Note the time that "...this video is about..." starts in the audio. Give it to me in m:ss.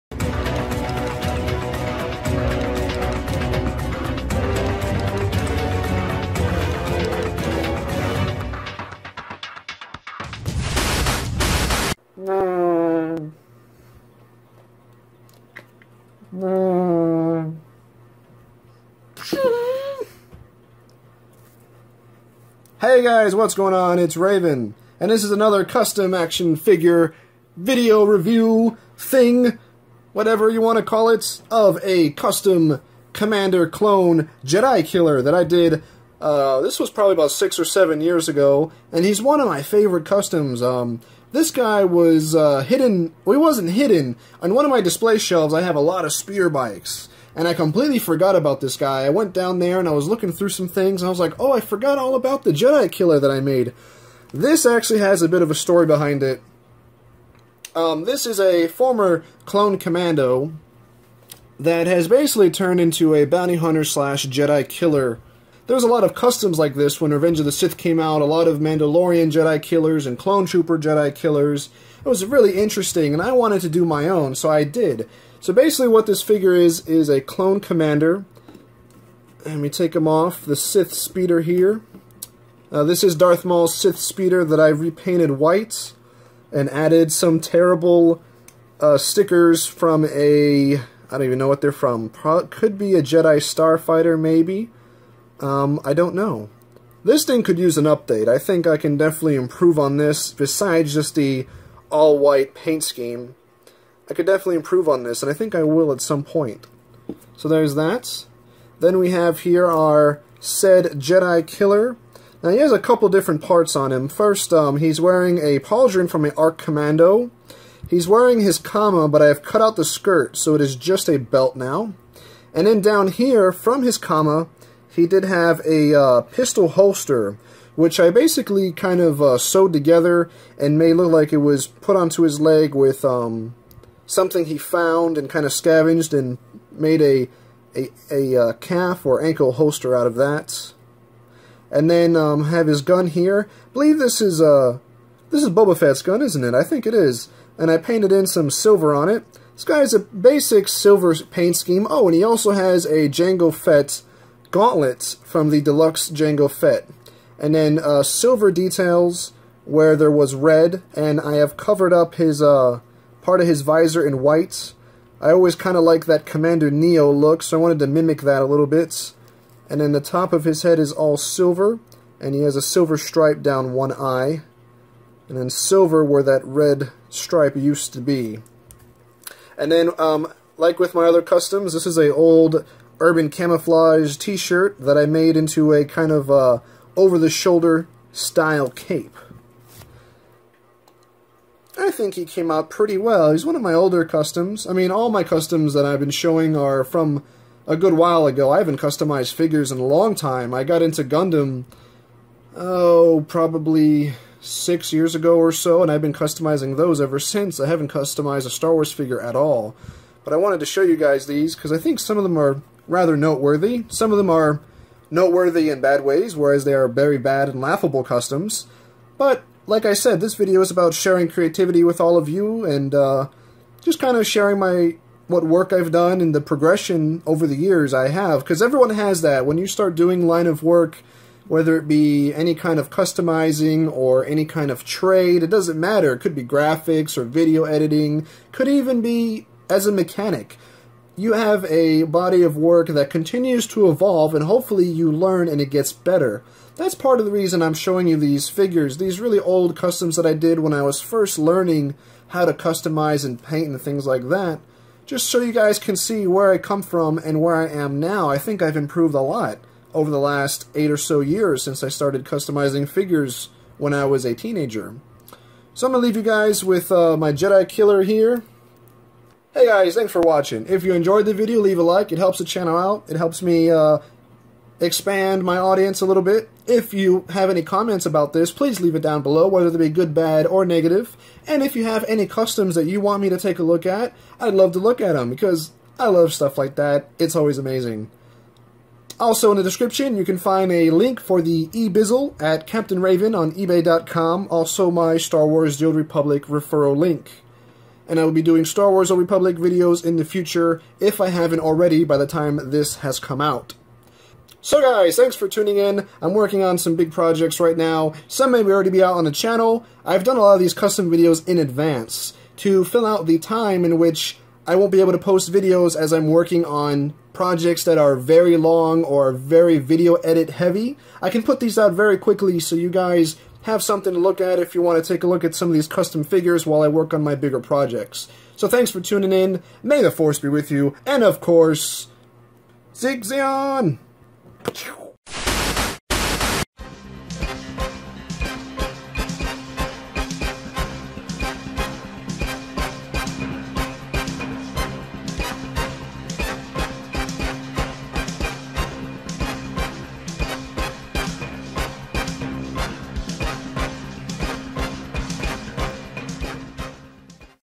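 3:40.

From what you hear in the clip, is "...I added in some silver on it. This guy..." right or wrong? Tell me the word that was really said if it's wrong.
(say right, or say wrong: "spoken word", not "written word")
wrong: "painted", not "added".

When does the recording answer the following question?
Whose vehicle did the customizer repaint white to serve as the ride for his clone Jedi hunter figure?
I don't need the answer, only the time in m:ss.
1:23.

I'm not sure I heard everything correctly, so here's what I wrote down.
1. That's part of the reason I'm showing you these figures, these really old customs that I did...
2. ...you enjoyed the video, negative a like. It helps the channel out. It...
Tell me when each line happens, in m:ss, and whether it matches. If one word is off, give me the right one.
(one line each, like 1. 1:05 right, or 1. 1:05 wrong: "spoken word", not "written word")
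1. 4:06 right
2. 4:30 wrong: "leave", not "negative".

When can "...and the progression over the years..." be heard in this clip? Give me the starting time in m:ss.
3:46.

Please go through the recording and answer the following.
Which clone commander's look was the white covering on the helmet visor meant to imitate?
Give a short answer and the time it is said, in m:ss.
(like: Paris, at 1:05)
Commander Neyo, at 2:46.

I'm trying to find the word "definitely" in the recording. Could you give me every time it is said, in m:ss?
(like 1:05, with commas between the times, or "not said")
1:38, 1:44.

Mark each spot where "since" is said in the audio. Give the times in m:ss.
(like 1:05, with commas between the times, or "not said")
3:27, 4:21.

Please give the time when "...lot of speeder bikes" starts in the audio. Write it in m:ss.
0:45.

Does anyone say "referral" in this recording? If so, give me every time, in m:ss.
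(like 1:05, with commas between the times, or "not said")
4:56.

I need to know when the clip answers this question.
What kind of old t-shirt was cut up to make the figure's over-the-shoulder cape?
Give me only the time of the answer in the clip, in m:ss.
3:03.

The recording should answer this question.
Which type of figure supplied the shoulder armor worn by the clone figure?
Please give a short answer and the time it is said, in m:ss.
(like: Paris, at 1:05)
Arc Commando, at 1:56.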